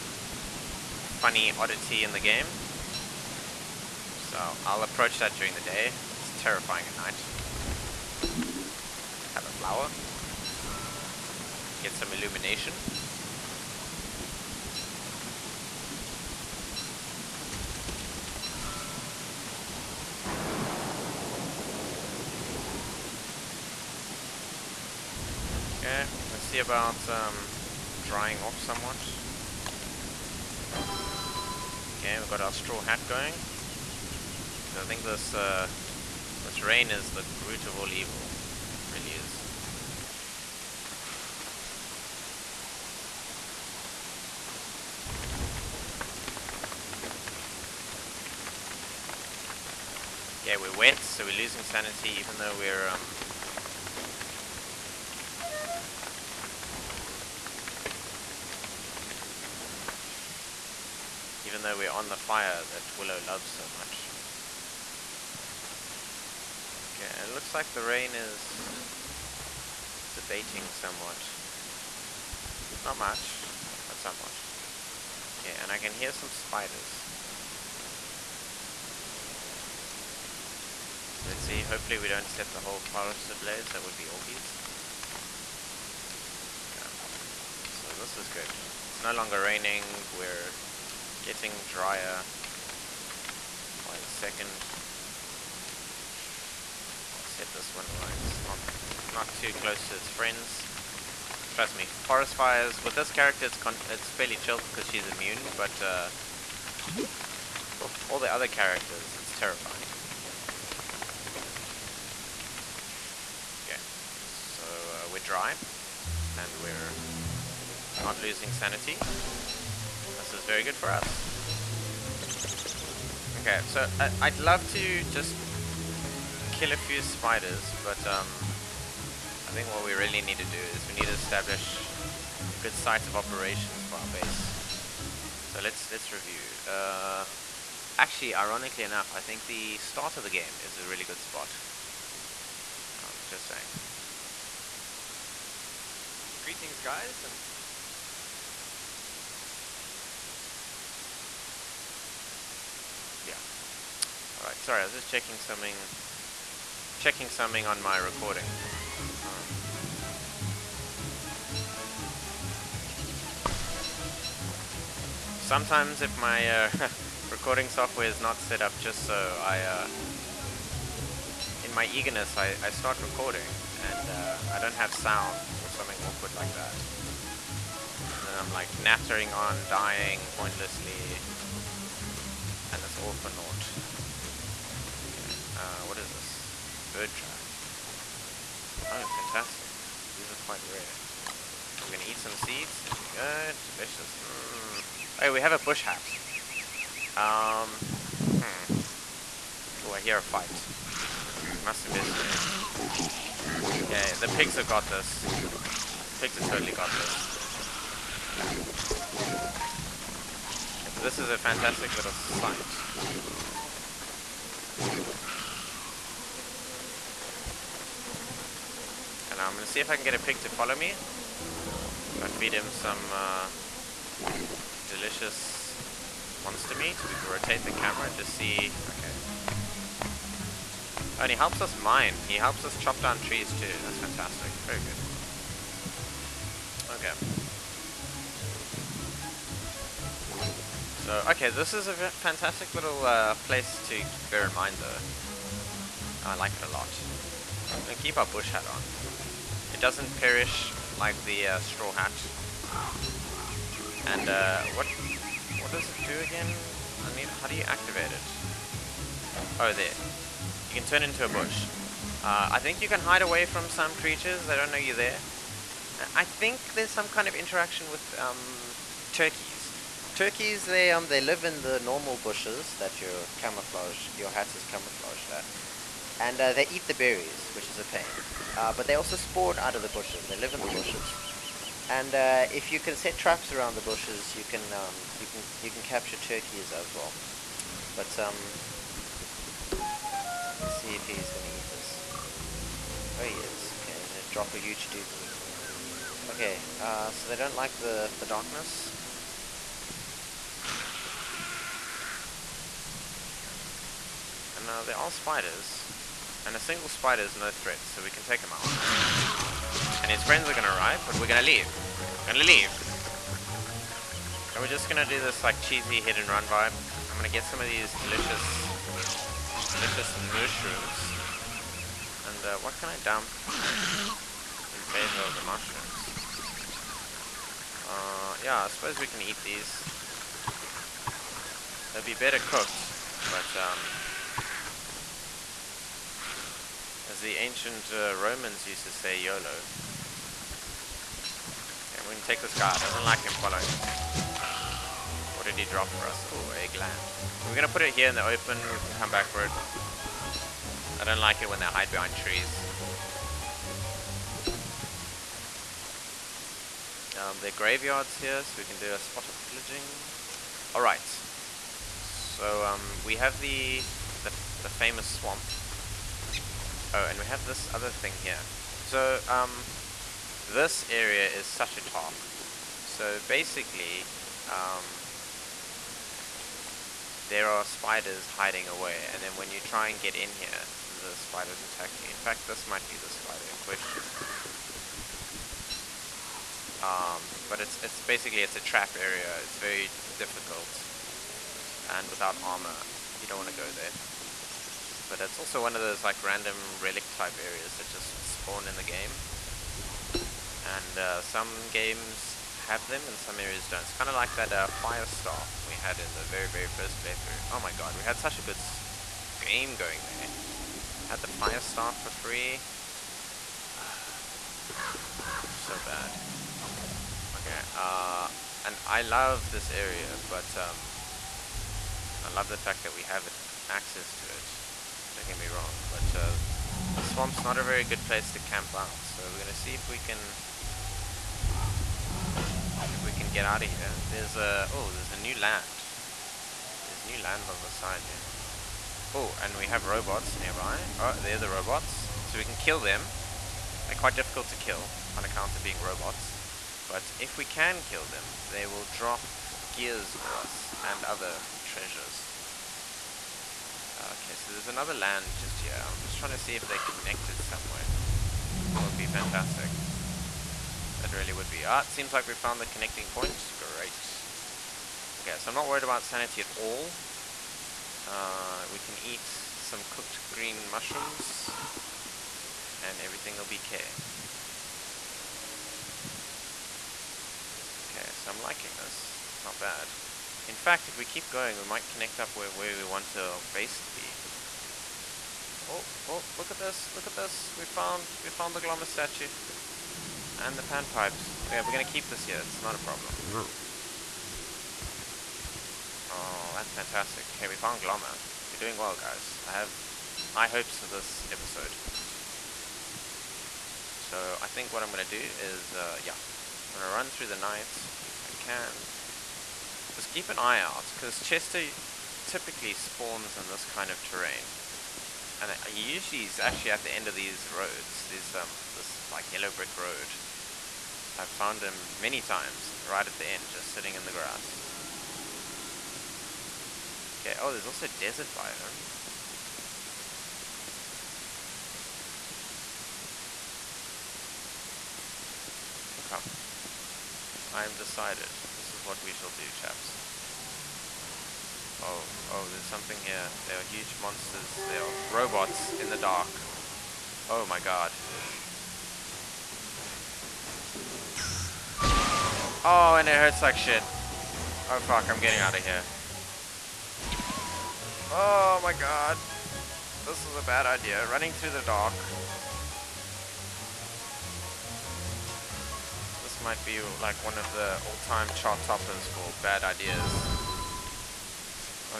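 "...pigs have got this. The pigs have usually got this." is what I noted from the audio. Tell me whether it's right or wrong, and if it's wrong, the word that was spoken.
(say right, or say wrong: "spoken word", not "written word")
wrong: "totally", not "usually".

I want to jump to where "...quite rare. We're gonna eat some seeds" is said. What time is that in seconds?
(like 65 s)
190 s.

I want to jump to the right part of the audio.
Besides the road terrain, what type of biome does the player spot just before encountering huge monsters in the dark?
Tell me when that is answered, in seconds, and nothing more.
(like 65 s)
527 s.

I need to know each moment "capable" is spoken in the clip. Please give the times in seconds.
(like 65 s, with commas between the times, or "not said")
not said.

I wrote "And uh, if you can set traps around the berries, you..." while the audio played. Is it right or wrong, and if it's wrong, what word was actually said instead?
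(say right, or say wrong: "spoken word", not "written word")
wrong: "bushes", not "berries".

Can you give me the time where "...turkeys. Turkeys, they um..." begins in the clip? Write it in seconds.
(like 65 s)
269 s.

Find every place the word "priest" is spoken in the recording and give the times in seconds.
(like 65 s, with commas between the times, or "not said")
not said.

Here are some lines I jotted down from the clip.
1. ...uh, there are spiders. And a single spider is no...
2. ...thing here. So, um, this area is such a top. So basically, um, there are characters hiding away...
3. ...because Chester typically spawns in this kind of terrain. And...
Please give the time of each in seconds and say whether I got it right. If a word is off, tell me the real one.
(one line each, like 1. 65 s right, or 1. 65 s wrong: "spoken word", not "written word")
1. 304 s right
2. 367 s wrong: "spiders", not "characters"
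3. 510 s right.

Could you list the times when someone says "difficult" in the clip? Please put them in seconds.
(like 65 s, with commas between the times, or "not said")
390 s, 444 s.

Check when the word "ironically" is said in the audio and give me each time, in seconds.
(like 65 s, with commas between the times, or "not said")
138 s.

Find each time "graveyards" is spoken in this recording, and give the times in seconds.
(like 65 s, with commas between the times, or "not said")
357 s.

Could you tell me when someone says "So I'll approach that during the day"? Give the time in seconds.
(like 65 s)
4 s.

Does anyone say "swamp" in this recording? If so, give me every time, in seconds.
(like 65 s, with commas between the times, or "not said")
365 s, 427 s.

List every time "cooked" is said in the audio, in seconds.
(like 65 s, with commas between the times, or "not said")
332 s, 469 s.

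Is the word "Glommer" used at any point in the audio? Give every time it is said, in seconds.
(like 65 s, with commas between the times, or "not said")
488 s, 497 s.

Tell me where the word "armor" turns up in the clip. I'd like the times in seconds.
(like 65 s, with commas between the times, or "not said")
392 s.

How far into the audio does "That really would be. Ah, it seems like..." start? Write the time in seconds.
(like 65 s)
460 s.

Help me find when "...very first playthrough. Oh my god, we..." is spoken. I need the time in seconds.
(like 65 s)
406 s.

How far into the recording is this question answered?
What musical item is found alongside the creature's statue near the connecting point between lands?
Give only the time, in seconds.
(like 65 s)
490 s.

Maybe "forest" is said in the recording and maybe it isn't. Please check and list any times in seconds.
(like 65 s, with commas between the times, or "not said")
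82 s, 102 s.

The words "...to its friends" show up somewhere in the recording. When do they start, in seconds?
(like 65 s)
99 s.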